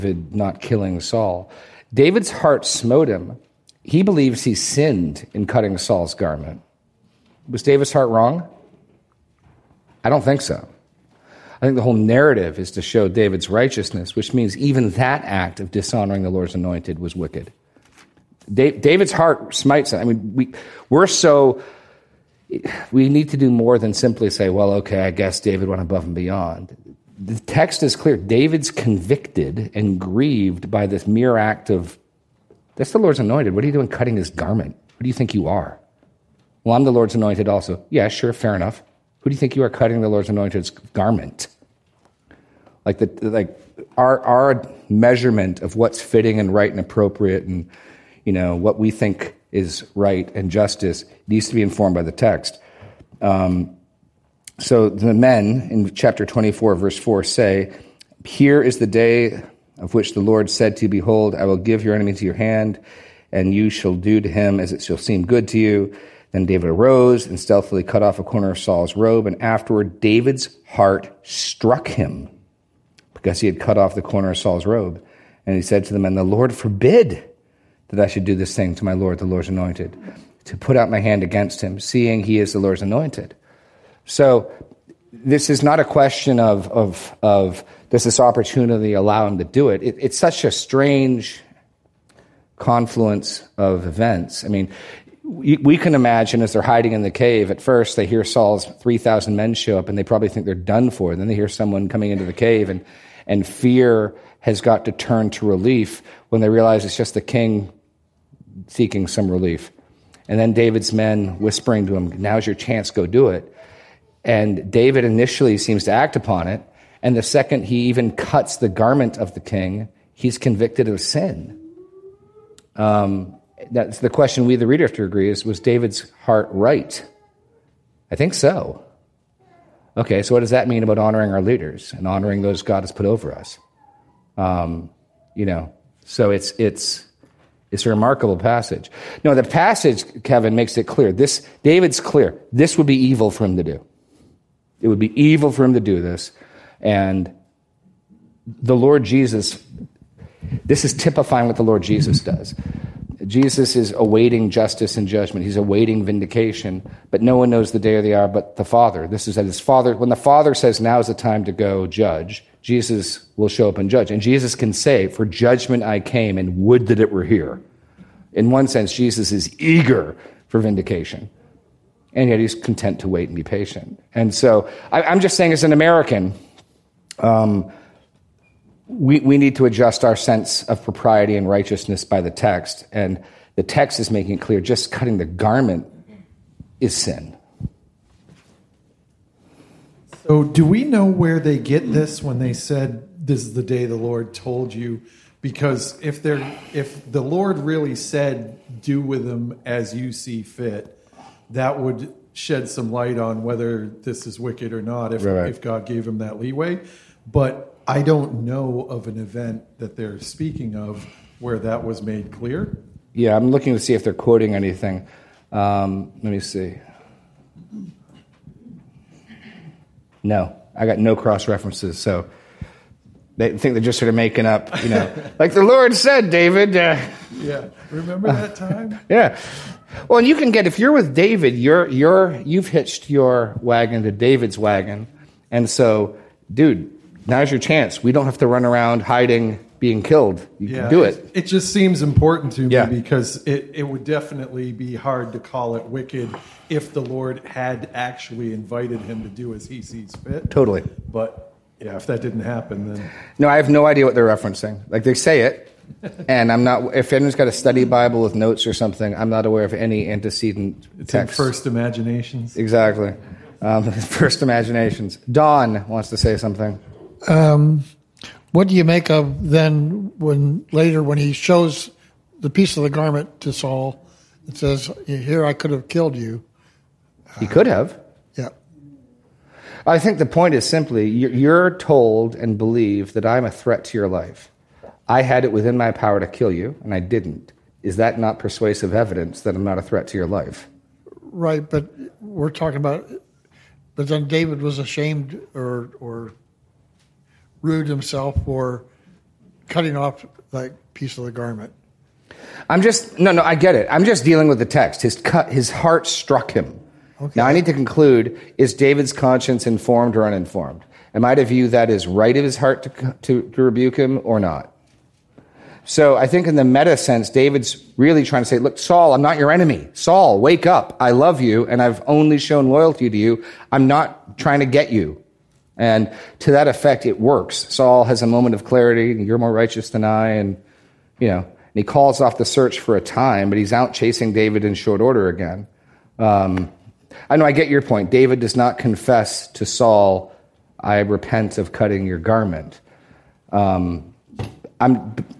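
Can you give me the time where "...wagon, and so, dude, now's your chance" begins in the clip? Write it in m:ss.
3:54.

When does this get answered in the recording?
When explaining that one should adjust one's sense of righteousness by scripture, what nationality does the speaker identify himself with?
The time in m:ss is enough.
2:55.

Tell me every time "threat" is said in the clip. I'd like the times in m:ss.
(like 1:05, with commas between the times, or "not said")
4:43, 4:49.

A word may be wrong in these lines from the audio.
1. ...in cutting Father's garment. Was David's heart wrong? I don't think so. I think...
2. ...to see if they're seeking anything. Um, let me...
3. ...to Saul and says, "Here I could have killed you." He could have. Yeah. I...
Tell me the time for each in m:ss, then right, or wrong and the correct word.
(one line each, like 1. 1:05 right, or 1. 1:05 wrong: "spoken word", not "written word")
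1. 0:05 wrong: "Saul", not "Father"
2. 3:33 wrong: "quoting", not "seeking"
3. 4:33 right.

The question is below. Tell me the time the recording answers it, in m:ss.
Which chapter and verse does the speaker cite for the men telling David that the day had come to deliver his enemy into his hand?
0:55.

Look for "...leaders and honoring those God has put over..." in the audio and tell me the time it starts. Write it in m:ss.
2:11.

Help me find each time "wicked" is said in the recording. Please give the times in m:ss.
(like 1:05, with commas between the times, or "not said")
0:17, 3:24, 4:05.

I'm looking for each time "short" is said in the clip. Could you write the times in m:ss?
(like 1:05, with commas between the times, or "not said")
5:34.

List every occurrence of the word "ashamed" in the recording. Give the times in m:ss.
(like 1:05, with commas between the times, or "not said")
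4:54.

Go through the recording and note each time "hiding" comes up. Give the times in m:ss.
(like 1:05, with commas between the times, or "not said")
1:36, 3:59.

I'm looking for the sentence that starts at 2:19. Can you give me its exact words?
No, the passage, Kevin, makes it clear.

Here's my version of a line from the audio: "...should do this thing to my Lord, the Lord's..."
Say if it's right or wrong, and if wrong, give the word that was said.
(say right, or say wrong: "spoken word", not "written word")
right.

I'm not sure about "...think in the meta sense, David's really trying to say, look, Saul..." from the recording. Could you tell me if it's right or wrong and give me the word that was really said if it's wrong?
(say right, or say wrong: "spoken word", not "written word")
right.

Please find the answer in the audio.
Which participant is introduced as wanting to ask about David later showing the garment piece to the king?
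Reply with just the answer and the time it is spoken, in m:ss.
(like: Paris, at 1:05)
Don, at 4:25.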